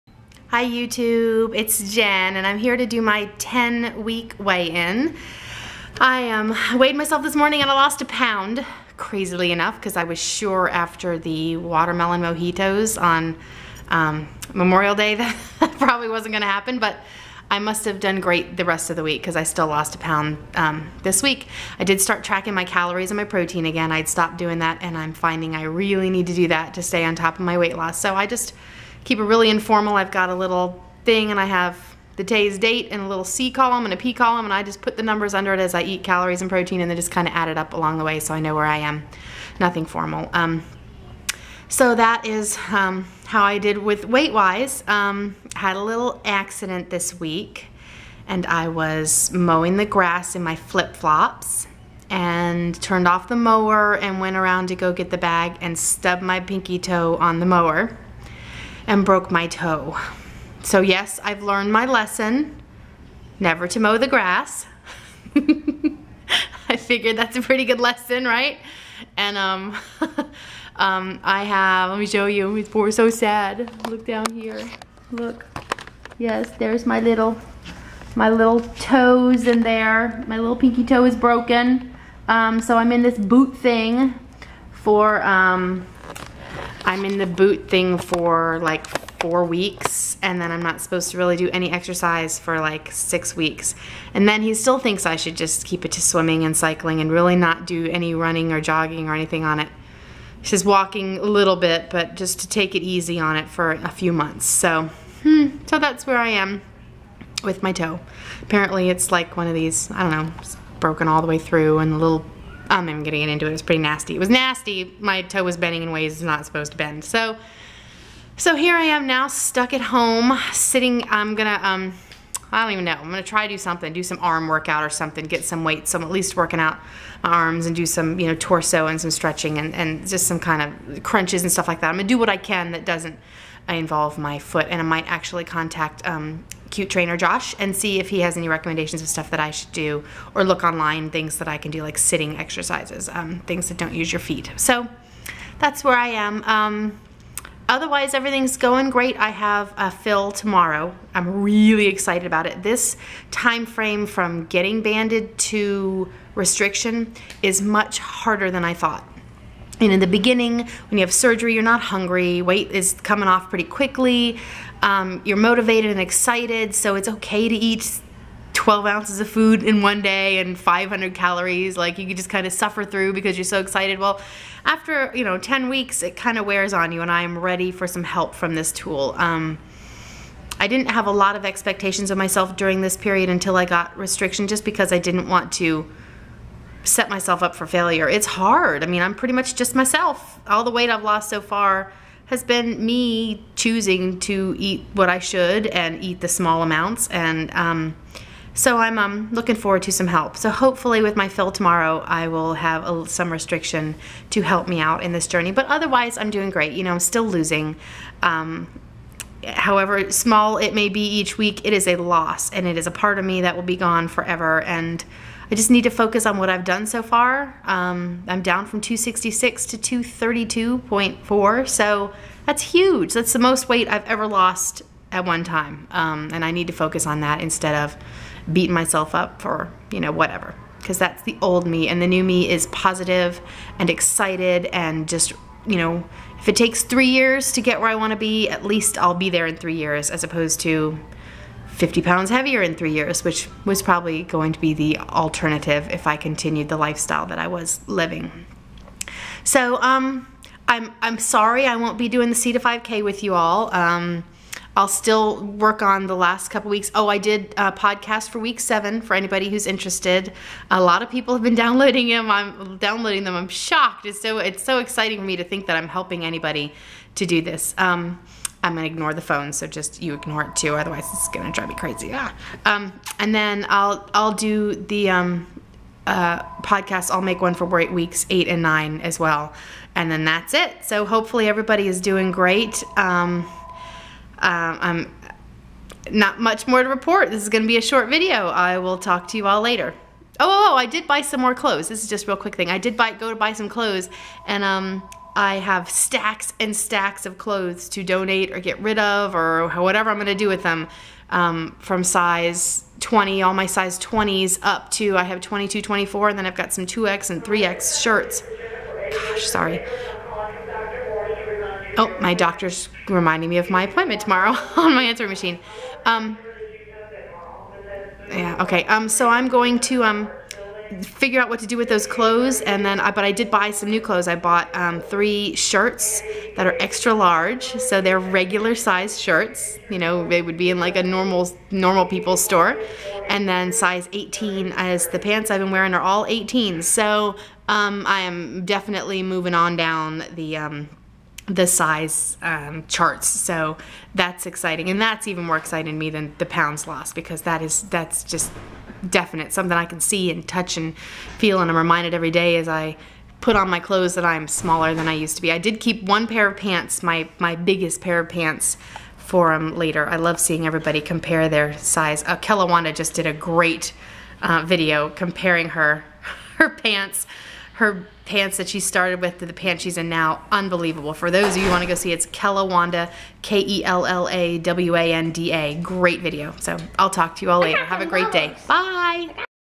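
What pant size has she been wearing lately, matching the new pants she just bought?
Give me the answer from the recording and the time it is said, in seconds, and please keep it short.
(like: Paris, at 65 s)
18, at 336 s.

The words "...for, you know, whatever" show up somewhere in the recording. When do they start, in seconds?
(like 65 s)
229 s.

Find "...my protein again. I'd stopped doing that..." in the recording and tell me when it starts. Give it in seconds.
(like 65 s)
23 s.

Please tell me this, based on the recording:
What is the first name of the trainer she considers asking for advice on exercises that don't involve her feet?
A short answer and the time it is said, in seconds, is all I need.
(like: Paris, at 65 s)
Josh, at 137 s.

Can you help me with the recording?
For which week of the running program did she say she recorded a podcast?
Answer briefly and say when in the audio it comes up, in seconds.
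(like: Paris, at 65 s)
week 7, at 258 s.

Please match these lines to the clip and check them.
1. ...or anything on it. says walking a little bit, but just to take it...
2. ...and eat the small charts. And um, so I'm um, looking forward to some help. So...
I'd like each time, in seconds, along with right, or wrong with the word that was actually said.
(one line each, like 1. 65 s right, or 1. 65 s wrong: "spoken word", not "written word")
1. 99 s right
2. 195 s wrong: "amounts", not "charts".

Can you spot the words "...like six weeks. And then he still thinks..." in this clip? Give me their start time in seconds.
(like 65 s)
92 s.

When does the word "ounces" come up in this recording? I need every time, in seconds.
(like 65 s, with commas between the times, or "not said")
168 s.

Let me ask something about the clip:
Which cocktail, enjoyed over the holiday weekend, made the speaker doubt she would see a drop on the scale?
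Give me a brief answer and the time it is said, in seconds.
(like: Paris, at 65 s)
watermelon mojitos, at 11 s.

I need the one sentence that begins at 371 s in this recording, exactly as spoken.
For those of you want to go see, it's Kellawanda, K E L L A W A N D A.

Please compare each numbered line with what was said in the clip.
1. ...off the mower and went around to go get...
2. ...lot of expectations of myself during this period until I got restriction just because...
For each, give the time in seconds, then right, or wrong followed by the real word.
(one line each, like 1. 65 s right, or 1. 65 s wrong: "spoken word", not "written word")
1. 53 s right
2. 181 s right.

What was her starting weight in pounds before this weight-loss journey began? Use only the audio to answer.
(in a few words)
266.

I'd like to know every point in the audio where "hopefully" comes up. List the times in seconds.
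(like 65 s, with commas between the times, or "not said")
200 s, 281 s.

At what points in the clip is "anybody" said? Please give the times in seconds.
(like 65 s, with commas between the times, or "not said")
259 s, 266 s.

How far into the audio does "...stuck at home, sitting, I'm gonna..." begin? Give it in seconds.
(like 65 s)
119 s.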